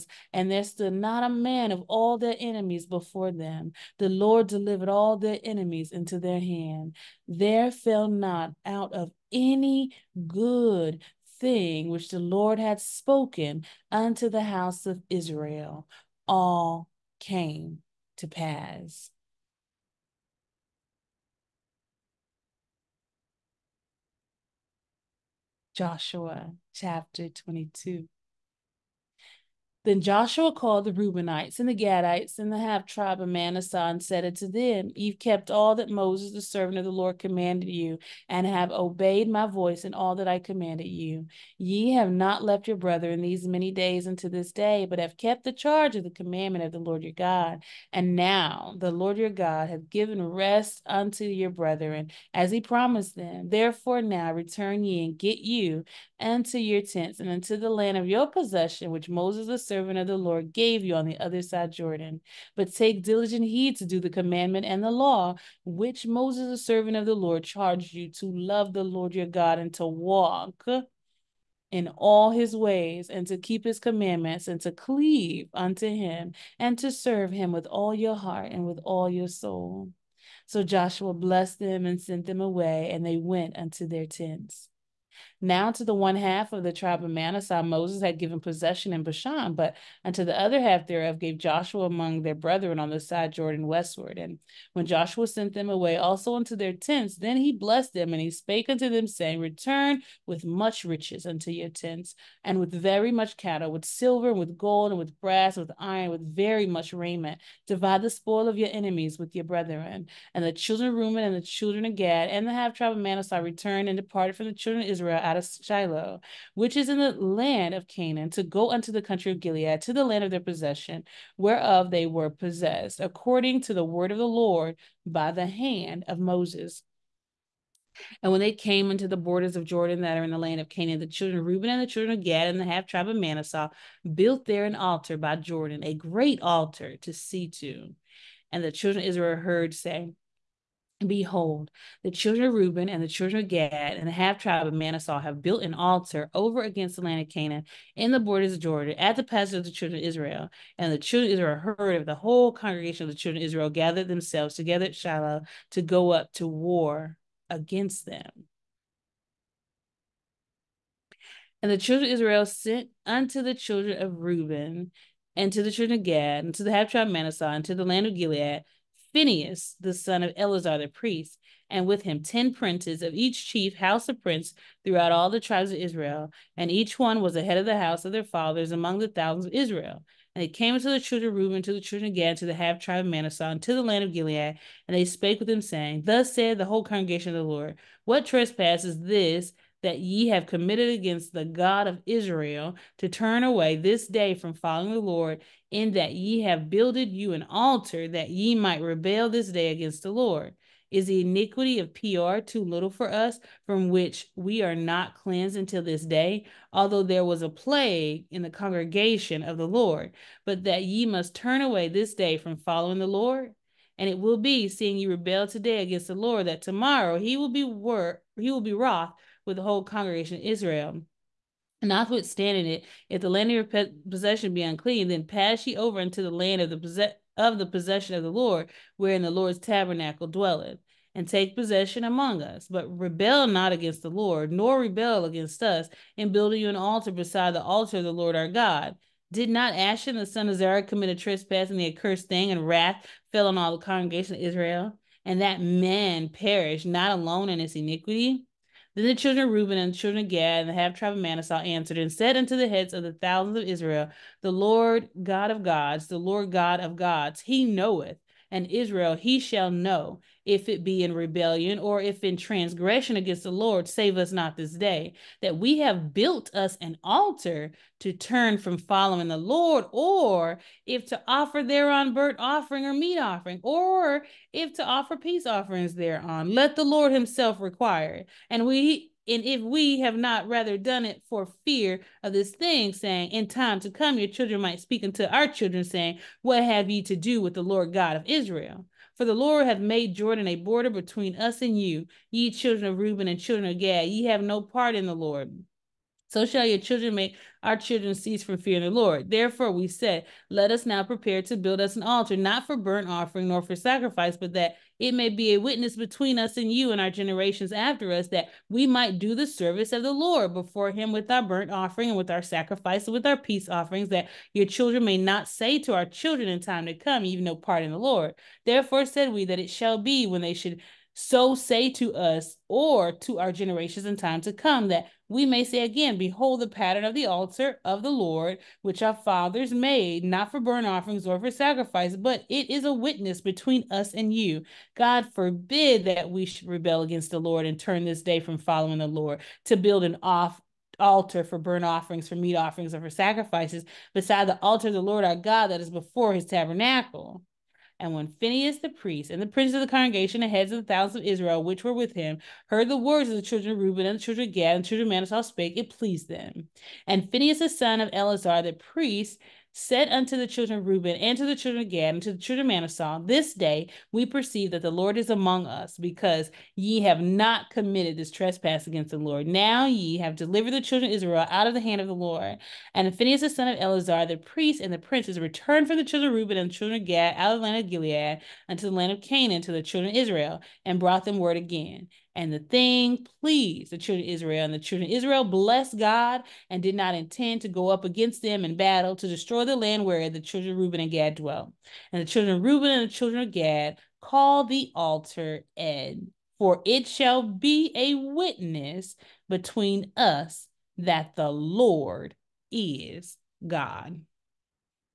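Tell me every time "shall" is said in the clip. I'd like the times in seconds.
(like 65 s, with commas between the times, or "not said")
259 s, 296 s, 319 s, 397 s.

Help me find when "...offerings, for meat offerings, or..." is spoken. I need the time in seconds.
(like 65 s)
341 s.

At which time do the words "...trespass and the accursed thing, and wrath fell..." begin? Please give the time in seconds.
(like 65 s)
241 s.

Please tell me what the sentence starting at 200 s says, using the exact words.
Is the iniquity of Peor too little for us, from which we are not cleansed until this day?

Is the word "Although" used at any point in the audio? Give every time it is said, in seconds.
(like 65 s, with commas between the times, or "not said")
206 s.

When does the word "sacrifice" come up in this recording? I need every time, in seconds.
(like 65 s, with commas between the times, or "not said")
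303 s, 312 s, 331 s, 343 s.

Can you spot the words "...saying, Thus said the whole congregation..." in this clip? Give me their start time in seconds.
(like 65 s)
185 s.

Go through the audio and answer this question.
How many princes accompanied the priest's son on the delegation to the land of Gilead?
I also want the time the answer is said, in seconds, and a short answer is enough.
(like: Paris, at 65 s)
10, at 172 s.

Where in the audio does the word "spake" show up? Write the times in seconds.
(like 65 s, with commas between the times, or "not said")
98 s, 185 s, 355 s.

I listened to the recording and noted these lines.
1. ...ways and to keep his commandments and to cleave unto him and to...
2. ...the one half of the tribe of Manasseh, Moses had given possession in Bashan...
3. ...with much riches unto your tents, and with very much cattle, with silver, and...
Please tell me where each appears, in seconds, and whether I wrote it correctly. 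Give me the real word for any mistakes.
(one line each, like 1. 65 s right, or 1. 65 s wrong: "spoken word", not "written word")
1. 72 s right
2. 85 s right
3. 100 s right.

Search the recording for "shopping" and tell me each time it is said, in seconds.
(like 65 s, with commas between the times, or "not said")
not said.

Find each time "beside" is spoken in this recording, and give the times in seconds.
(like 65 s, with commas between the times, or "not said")
237 s, 344 s.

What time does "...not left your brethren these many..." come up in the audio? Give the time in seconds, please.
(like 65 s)
42 s.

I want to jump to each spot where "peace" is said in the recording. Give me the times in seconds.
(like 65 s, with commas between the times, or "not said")
275 s, 313 s.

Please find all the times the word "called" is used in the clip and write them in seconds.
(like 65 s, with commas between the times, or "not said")
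30 s, 394 s.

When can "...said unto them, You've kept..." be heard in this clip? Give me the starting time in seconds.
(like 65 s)
34 s.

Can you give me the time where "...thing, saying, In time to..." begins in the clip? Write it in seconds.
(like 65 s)
282 s.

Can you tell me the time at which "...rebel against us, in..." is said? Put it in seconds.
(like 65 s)
234 s.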